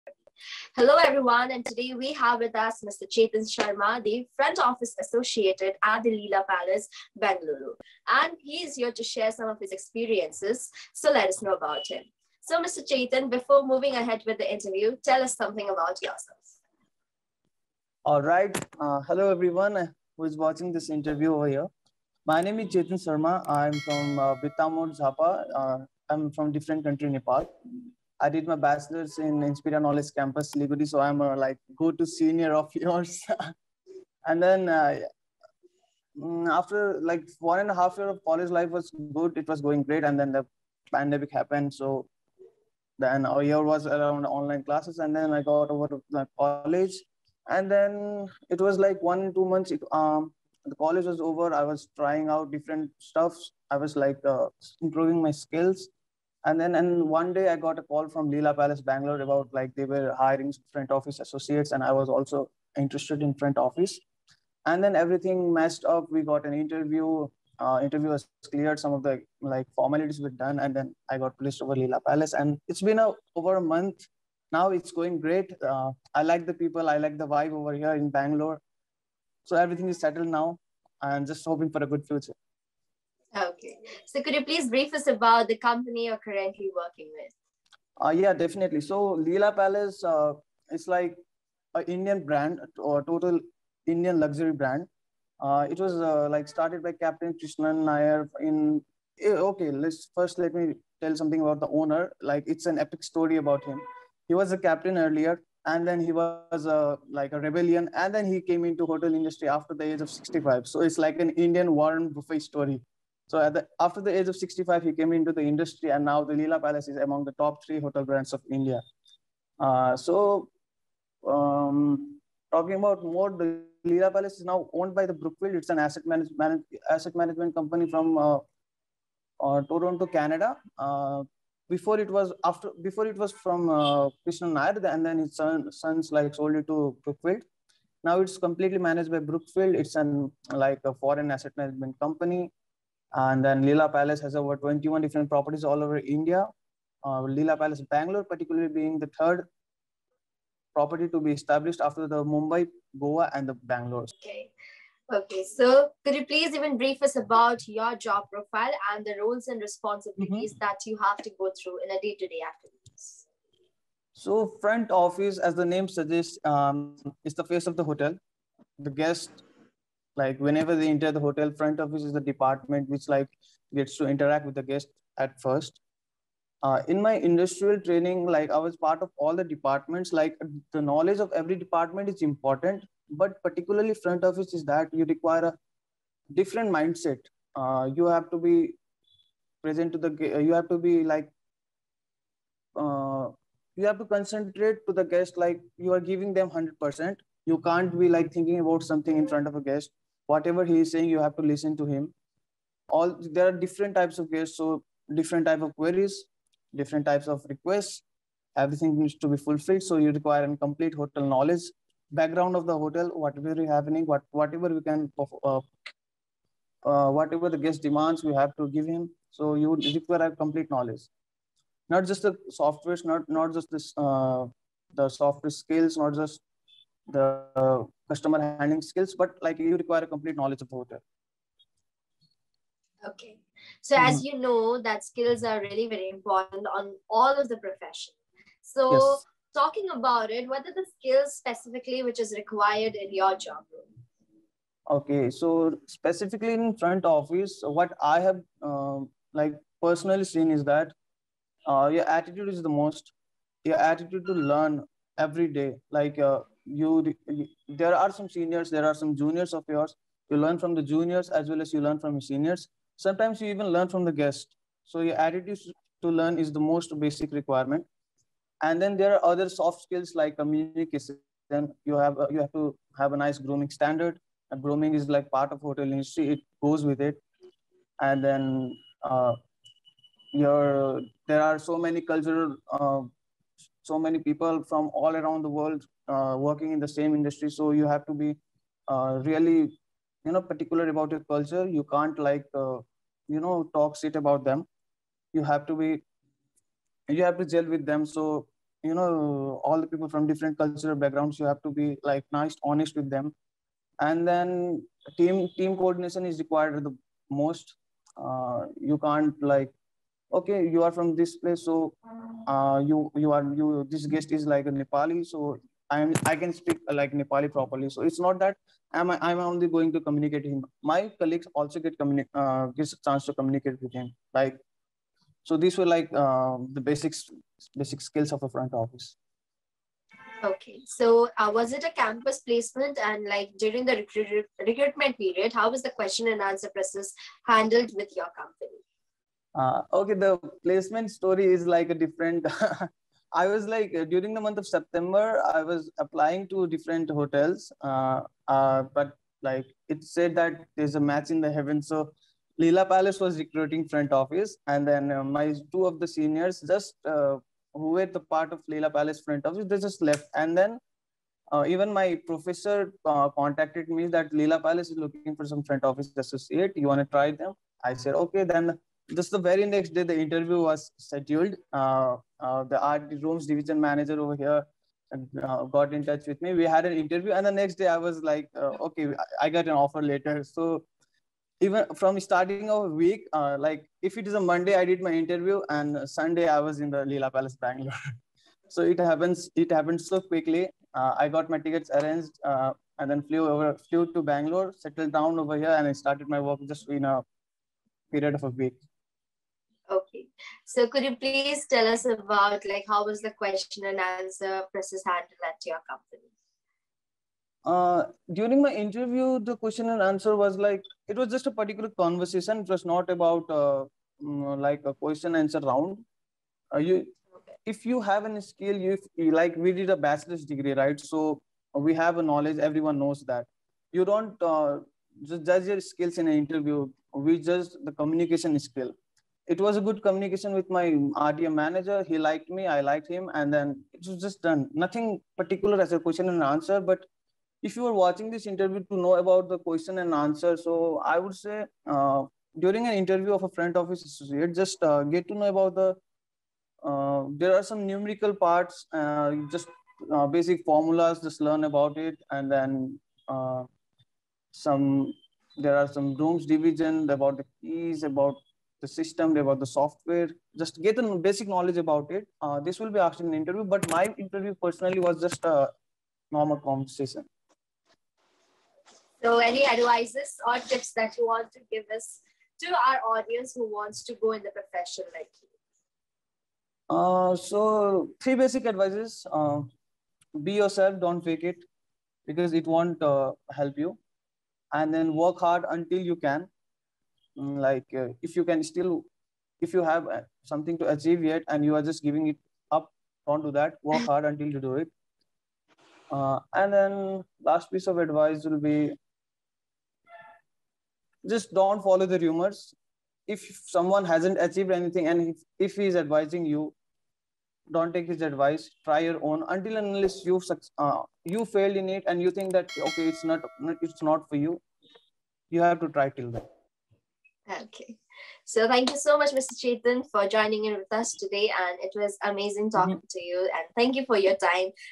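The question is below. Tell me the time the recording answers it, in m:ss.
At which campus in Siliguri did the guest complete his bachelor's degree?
0:29.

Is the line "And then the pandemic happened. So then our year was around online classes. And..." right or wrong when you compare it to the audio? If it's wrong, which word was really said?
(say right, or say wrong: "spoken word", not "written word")
right.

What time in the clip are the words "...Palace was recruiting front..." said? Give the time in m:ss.
5:52.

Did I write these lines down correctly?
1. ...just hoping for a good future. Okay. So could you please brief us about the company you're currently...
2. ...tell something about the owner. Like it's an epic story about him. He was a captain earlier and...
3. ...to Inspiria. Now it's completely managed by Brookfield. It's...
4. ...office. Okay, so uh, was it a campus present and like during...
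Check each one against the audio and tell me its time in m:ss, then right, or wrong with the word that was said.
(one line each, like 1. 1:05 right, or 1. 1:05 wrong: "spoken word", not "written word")
1. 1:21 right
2. 1:41 right
3. 2:16 wrong: "Brookfield", not "Inspiria"
4. 5:28 wrong: "placement", not "present".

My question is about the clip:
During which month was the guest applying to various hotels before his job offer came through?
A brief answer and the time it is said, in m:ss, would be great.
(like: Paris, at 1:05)
September, at 5:44.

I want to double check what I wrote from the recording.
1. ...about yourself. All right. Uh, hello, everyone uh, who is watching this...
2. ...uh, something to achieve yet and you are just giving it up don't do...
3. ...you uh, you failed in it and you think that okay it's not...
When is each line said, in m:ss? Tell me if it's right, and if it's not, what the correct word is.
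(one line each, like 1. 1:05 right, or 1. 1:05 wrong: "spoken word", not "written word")
1. 0:15 right
2. 8:10 right
3. 8:30 right.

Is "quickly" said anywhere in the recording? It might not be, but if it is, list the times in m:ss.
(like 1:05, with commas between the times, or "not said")
6:30.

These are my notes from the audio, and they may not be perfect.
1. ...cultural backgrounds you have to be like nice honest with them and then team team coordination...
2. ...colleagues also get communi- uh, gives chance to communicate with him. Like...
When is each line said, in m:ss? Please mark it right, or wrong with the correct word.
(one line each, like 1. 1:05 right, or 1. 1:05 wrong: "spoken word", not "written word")
1. 5:00 right
2. 5:21 right.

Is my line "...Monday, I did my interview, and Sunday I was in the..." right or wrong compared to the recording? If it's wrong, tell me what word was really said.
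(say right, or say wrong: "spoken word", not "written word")
right.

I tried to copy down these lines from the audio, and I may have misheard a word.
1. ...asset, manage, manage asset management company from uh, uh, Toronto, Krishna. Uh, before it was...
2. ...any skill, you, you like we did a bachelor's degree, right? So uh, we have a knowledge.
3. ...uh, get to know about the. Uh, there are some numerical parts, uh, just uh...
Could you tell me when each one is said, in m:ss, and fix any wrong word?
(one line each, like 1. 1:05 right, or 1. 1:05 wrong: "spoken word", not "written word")
1. 2:05 wrong: "Canada", not "Krishna"
2. 6:58 right
3. 7:24 right.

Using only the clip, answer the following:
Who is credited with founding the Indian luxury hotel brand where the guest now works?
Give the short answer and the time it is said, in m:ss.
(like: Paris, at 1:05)
Captain Krishnan Nair, at 1:36.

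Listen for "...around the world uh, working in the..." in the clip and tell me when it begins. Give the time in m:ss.
4:45.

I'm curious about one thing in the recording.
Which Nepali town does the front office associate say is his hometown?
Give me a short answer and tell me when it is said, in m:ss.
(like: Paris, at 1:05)
Birtamod, at 0:24.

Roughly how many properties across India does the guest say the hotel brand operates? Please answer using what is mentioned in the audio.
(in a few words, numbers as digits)
21.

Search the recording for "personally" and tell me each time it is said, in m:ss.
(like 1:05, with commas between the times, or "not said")
4:09, 7:44.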